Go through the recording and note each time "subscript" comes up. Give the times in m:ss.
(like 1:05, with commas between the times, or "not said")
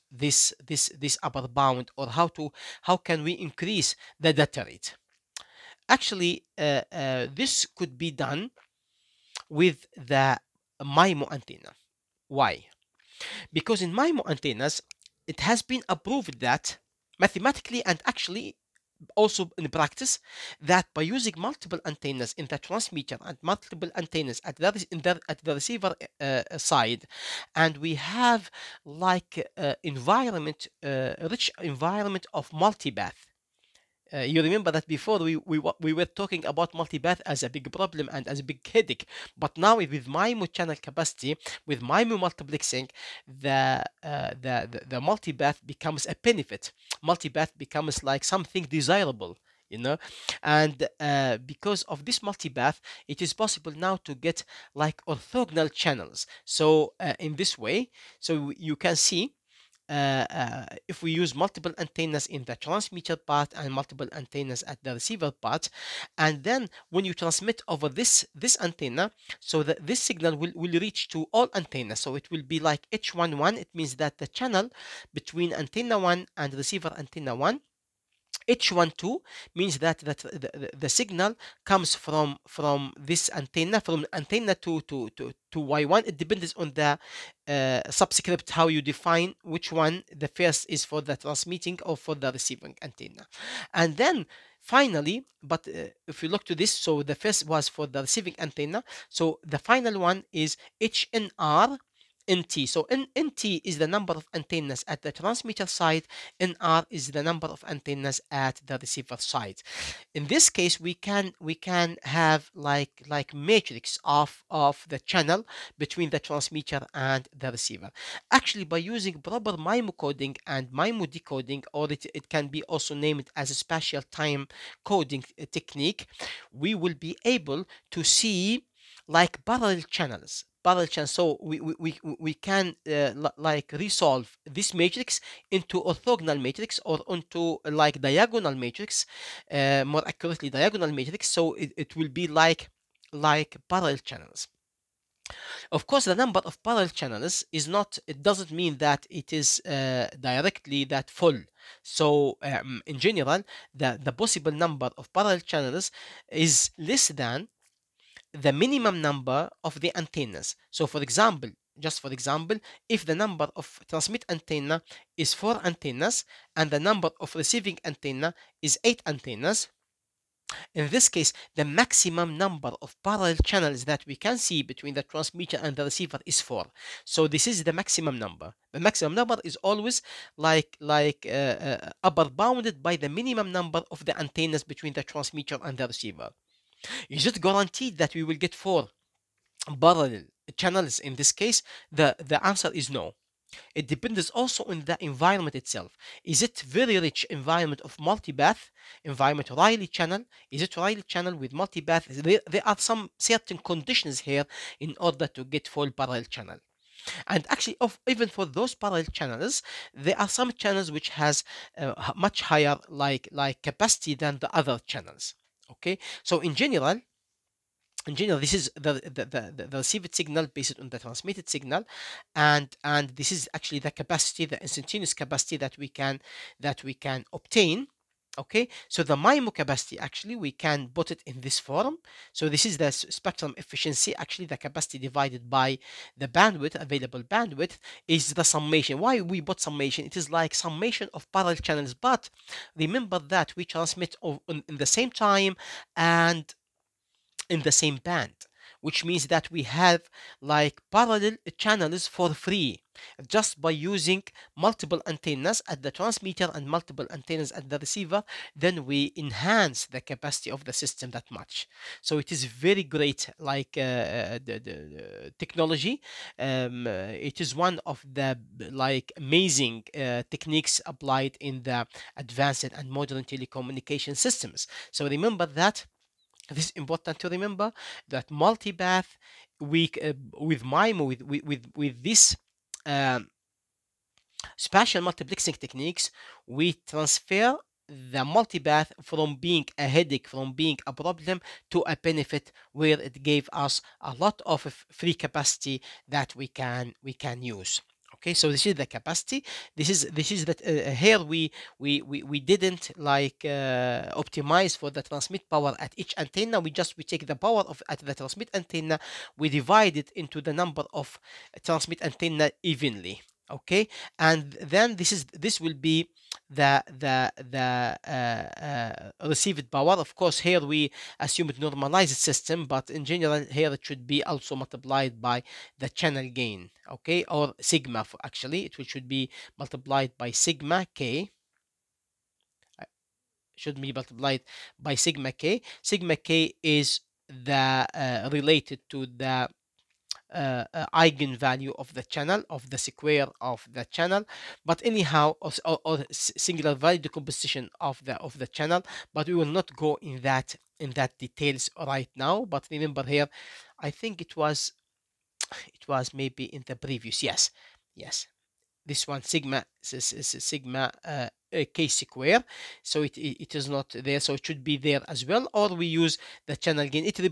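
1:27.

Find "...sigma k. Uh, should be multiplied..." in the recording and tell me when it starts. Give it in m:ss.
5:30.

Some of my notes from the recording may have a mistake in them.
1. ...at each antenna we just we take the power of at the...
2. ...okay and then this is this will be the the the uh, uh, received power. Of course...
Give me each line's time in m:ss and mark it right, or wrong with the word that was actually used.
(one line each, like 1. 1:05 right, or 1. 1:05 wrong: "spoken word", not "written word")
1. 5:05 right
2. 5:13 right.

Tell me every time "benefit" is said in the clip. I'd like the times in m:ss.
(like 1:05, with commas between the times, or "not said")
0:46, 4:51.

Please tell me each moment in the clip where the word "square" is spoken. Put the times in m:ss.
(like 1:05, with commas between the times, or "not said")
5:42, 6:01.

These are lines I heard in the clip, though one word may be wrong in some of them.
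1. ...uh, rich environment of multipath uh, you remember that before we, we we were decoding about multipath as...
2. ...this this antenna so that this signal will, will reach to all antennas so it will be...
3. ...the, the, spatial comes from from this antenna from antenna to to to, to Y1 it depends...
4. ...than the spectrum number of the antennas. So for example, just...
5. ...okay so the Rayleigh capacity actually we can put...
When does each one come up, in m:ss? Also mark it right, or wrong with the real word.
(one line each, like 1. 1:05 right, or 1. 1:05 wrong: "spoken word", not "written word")
1. 0:30 wrong: "talking", not "decoding"
2. 1:07 right
3. 1:20 wrong: "signal", not "spatial"
4. 2:37 wrong: "minimum", not "spectrum"
5. 3:48 wrong: "MIMO", not "Rayleigh".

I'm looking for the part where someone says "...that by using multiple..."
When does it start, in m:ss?
0:20.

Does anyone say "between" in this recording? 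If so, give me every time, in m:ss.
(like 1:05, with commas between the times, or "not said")
1:15, 1:55, 2:54, 3:04.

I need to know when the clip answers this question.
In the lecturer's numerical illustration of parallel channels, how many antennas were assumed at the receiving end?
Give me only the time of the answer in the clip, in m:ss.
2:48.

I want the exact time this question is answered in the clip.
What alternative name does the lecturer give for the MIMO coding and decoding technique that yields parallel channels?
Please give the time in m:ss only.
2:03.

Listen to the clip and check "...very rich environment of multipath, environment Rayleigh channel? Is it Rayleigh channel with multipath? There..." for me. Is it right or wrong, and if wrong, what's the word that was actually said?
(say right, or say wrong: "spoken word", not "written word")
right.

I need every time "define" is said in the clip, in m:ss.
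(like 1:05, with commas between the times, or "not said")
1:28.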